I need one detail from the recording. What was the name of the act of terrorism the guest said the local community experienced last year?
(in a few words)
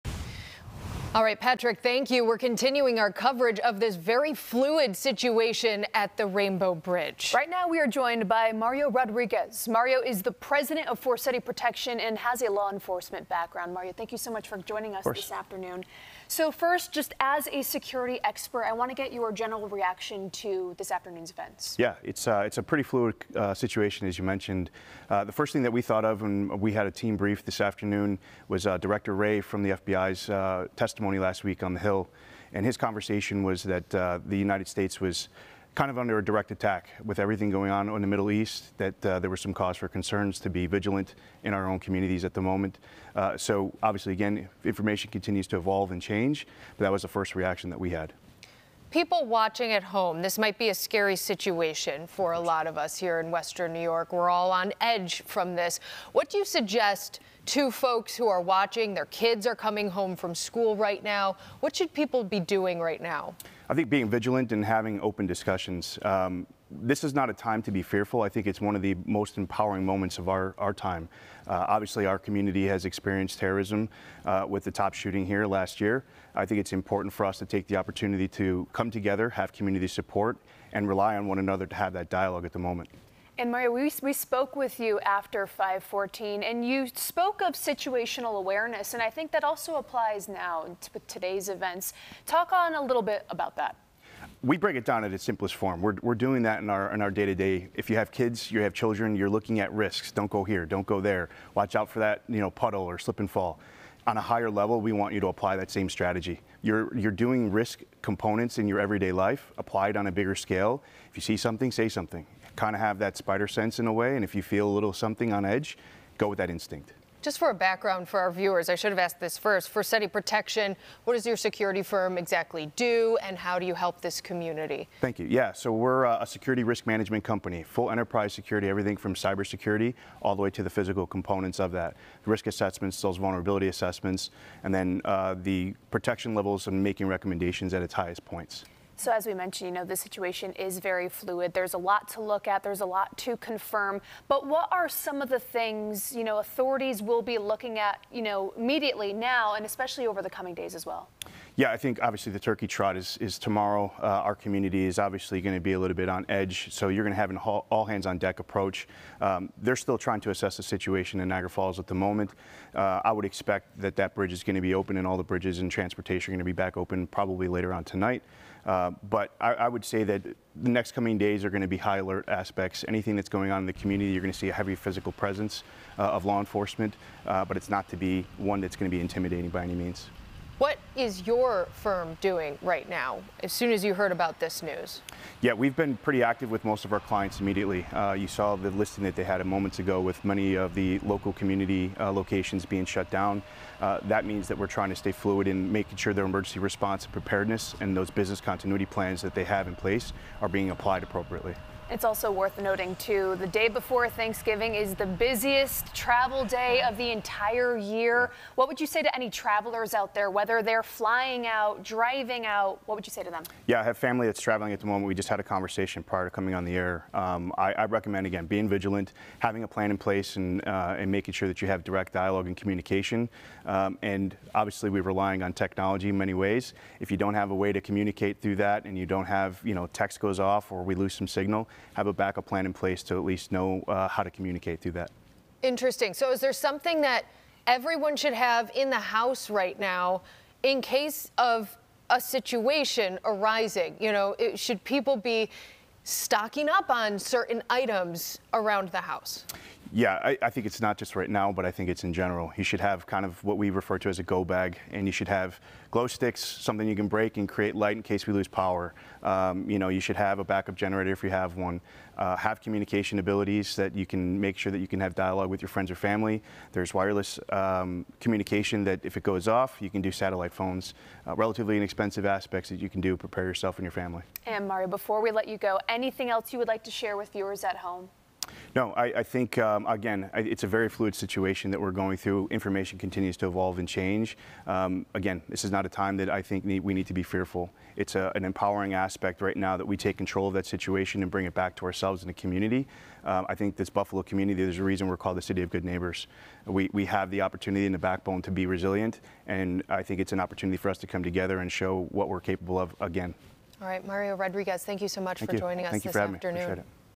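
Tops shooting.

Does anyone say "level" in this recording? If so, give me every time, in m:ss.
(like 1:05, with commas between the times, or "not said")
1:44, 2:16.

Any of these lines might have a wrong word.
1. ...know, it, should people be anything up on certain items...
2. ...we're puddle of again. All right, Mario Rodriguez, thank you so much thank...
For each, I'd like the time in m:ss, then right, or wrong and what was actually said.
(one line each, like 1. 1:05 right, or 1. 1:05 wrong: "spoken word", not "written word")
1. 4:04 wrong: "stocking", not "anything"
2. 5:02 wrong: "capable", not "puddle".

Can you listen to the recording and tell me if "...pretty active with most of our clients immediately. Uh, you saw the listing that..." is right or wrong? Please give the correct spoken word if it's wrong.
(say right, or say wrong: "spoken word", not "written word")
right.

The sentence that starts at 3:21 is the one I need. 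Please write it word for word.
It's also worth noting, too, the day before Thanksgiving is the busiest travel day of the entire year.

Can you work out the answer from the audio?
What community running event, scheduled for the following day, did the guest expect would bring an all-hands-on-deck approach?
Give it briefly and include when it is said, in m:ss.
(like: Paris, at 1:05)
Turkey trot, at 2:32.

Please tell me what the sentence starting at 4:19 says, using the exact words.
Um, you know, you should have a backup generator if you have one.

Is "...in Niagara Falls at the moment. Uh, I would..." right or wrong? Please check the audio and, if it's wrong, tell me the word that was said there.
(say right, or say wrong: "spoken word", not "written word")
right.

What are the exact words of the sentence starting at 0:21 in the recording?
Yeah, it's, uh, it's a pretty fluid uh, situation, as you mentioned.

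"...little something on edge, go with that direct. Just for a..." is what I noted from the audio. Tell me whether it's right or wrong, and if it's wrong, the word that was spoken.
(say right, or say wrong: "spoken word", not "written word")
wrong: "instinct", not "direct".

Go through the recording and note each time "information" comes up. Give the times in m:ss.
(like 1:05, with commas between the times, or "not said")
0:44, 4:42.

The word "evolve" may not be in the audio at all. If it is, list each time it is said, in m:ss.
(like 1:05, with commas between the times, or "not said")
0:45, 4:43.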